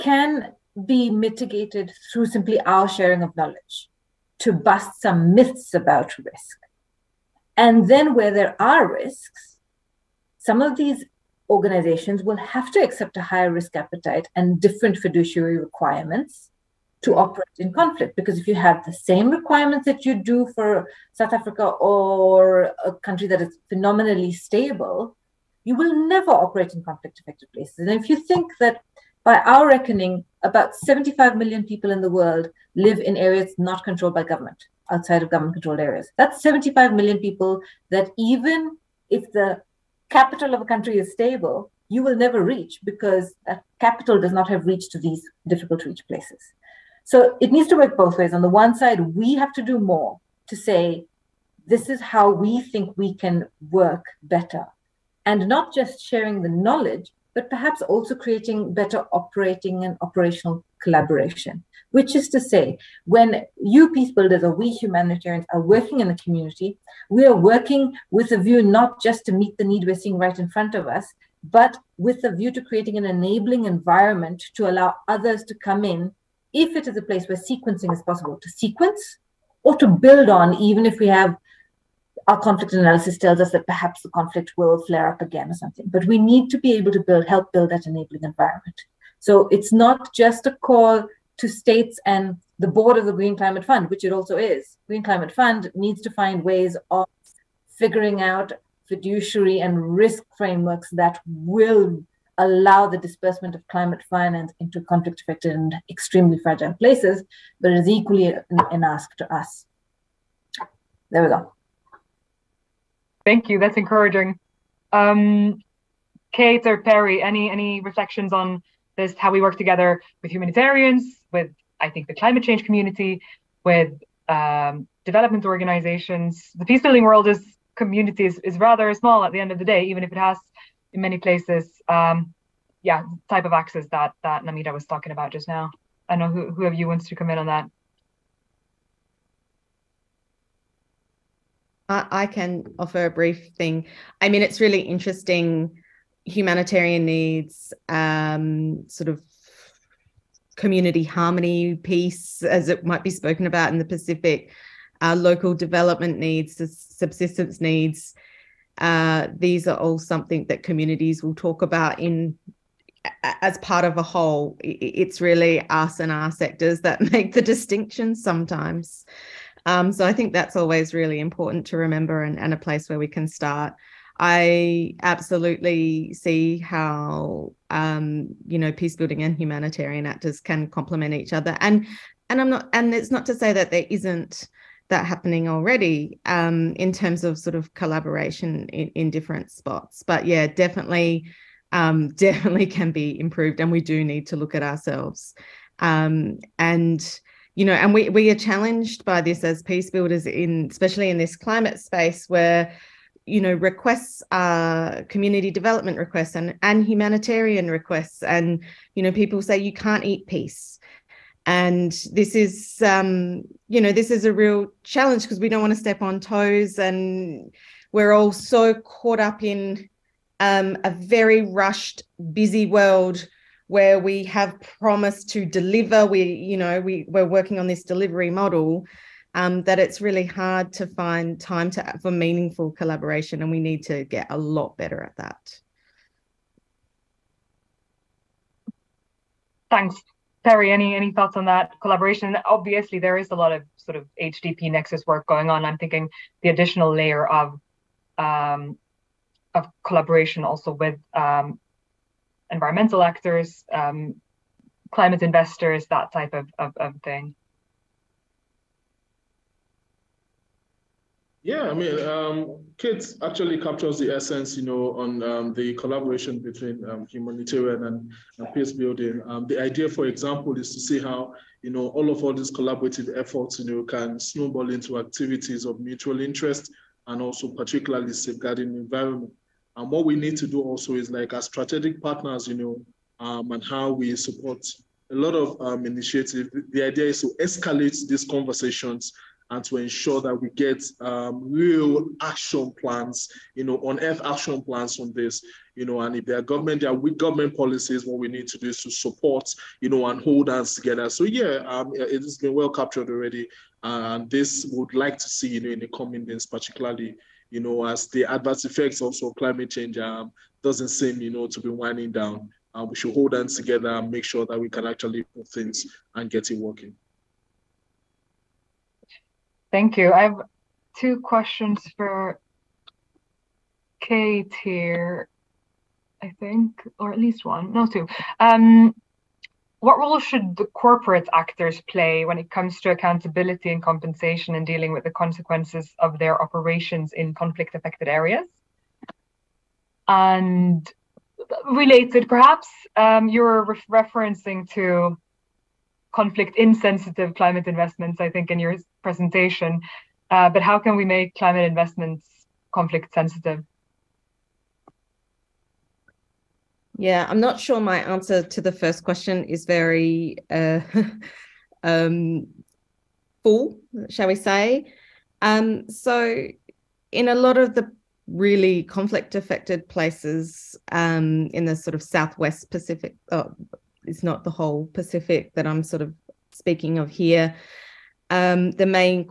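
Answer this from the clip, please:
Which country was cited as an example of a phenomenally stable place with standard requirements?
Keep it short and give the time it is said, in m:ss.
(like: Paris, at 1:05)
South Africa, at 0:21.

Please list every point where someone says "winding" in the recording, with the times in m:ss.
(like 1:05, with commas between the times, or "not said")
5:11.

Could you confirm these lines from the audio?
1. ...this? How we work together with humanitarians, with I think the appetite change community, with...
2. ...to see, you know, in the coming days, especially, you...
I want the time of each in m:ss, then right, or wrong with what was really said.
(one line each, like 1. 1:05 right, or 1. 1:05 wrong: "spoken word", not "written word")
1. 1:58 wrong: "climate", not "appetite"
2. 5:05 wrong: "particularly", not "especially".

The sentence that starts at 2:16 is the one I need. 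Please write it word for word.
I know who whoever you wants to come in on that.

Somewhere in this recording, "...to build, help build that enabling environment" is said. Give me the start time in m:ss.
1:26.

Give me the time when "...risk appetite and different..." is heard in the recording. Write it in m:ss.
0:13.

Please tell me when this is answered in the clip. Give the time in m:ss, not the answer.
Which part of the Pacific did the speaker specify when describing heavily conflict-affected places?
6:12.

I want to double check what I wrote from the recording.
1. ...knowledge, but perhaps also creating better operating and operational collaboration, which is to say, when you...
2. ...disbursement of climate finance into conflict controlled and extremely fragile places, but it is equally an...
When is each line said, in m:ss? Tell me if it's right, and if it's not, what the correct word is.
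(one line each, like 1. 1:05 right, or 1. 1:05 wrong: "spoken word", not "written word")
1. 0:56 right
2. 1:42 wrong: "affected", not "controlled".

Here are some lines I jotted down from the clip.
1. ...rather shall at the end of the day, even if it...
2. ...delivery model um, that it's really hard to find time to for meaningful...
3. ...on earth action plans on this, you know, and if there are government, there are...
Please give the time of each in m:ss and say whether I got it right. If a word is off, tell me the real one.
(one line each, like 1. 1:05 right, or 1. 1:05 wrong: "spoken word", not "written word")
1. 2:08 wrong: "small", not "shall"
2. 3:47 right
3. 4:53 right.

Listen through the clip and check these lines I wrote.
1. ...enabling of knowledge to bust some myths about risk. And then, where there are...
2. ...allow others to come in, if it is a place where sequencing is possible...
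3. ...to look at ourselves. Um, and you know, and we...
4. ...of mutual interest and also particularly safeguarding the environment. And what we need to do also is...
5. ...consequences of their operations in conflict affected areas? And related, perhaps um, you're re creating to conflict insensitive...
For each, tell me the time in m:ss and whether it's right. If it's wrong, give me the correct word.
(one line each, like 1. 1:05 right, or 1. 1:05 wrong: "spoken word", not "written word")
1. 0:02 wrong: "sharing", not "enabling"
2. 1:14 right
3. 3:14 right
4. 4:35 right
5. 5:35 wrong: "referencing", not "creating".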